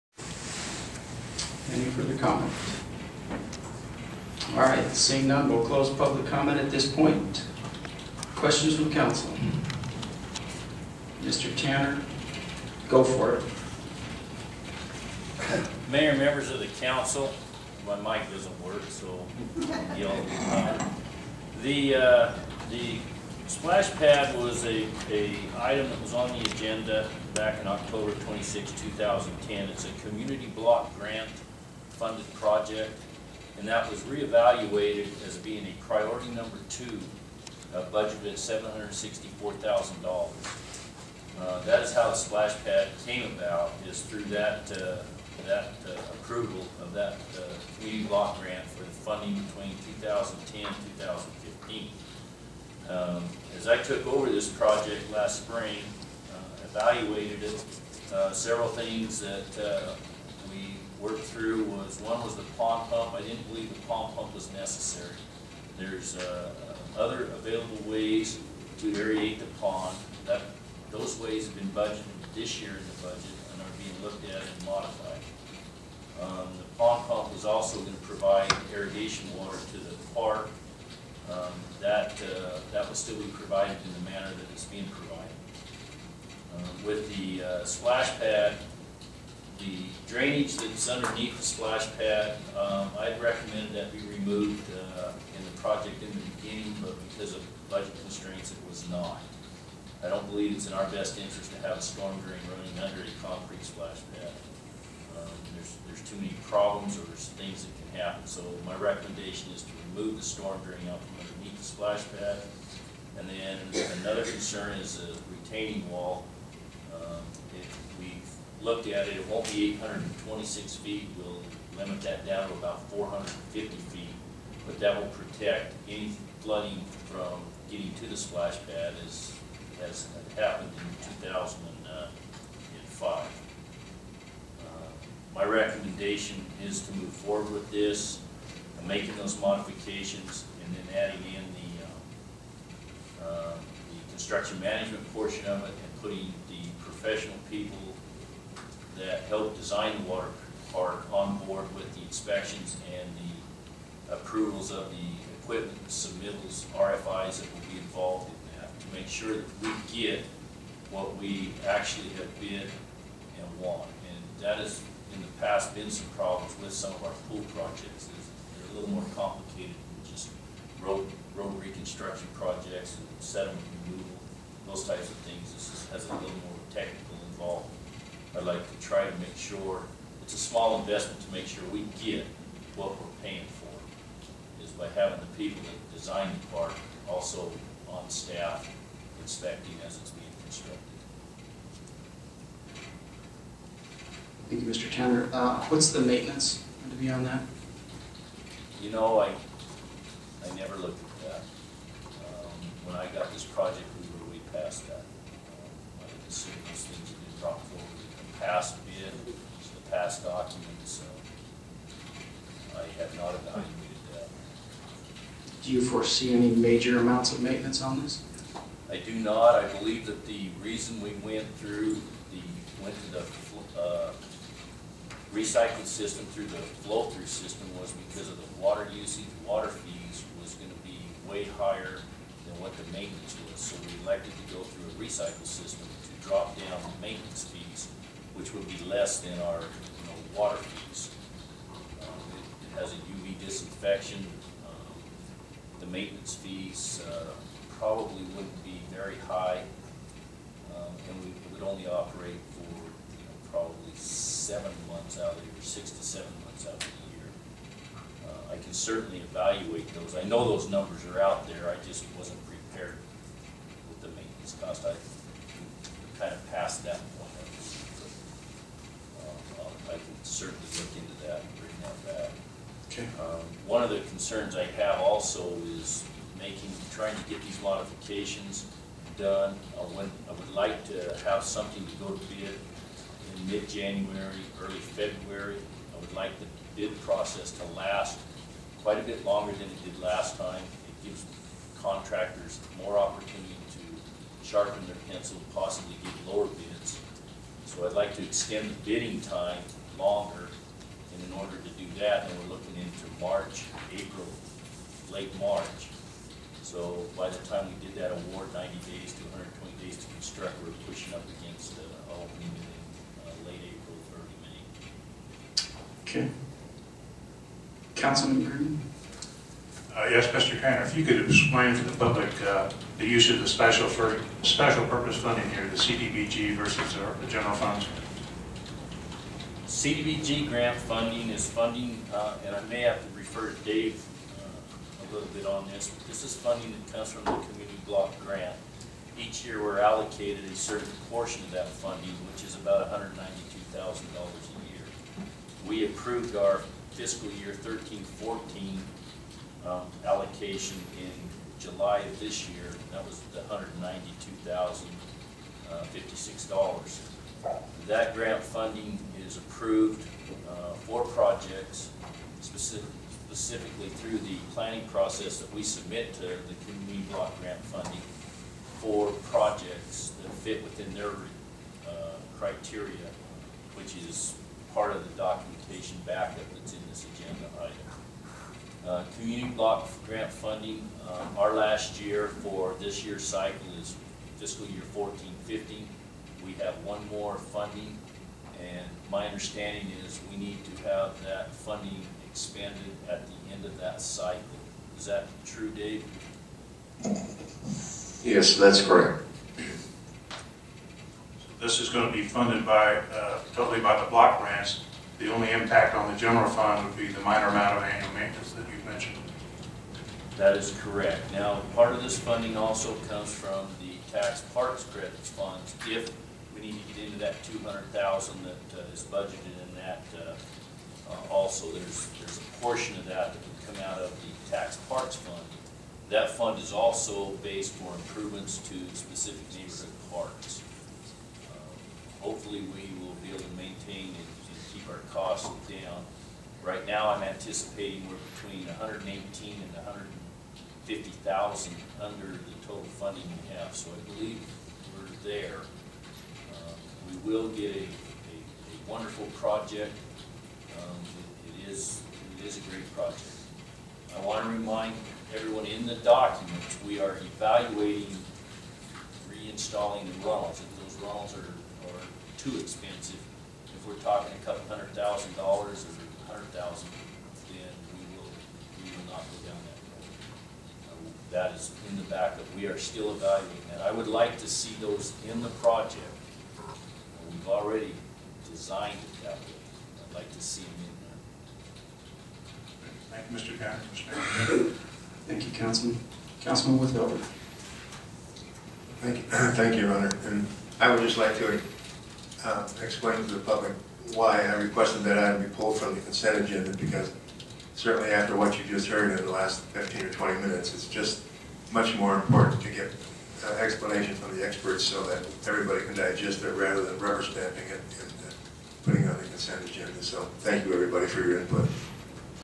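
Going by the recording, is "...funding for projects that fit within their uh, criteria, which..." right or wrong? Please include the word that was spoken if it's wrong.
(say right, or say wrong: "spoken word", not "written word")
right.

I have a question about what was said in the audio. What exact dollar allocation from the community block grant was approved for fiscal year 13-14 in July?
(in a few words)
$192,056.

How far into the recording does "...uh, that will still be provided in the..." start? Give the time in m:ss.
1:22.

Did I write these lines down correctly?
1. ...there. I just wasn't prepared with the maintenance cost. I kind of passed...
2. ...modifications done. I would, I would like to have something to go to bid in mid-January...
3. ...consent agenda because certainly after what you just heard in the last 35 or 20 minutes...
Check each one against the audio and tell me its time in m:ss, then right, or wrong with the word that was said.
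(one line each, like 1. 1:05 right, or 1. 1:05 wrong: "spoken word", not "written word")
1. 4:21 right
2. 4:37 right
3. 8:16 wrong: "15", not "35".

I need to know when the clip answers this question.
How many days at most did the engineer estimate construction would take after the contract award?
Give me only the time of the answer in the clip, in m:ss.
5:09.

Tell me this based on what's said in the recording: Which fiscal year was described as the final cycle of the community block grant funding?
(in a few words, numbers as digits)
fiscal year 14-15.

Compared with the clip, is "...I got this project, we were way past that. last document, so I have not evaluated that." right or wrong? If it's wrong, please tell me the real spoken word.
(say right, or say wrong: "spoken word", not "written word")
right.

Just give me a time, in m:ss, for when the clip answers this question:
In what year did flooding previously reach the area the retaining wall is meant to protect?
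2:11.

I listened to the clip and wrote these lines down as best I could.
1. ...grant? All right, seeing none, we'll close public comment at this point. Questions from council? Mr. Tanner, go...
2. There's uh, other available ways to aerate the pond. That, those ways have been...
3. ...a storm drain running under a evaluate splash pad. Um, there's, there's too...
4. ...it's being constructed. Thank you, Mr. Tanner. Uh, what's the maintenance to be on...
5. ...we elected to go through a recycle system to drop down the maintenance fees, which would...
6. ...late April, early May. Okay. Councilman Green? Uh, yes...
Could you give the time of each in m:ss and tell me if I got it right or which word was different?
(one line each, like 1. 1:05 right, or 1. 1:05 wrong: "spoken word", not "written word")
1. 0:02 wrong: "comment", not "grant"
2. 1:05 right
3. 1:41 wrong: "concrete", not "evaluate"
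4. 3:09 right
5. 3:53 right
6. 5:13 right.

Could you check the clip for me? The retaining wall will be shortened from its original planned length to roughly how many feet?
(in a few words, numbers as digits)
450 feet.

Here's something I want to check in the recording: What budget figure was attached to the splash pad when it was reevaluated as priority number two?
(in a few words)
$764,000.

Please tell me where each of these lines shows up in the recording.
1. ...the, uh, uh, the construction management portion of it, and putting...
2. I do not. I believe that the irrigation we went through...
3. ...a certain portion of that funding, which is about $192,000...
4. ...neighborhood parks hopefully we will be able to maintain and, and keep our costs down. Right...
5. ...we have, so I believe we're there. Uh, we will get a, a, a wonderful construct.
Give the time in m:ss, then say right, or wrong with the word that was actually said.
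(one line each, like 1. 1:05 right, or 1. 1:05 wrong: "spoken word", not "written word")
1. 2:23 right
2. 3:38 wrong: "reason", not "irrigation"
3. 5:40 right
4. 7:09 right
5. 7:23 wrong: "project", not "construct".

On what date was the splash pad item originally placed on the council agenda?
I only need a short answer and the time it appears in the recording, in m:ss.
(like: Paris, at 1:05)
October 26, 2010, at 0:27.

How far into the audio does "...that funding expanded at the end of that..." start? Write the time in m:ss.
6:31.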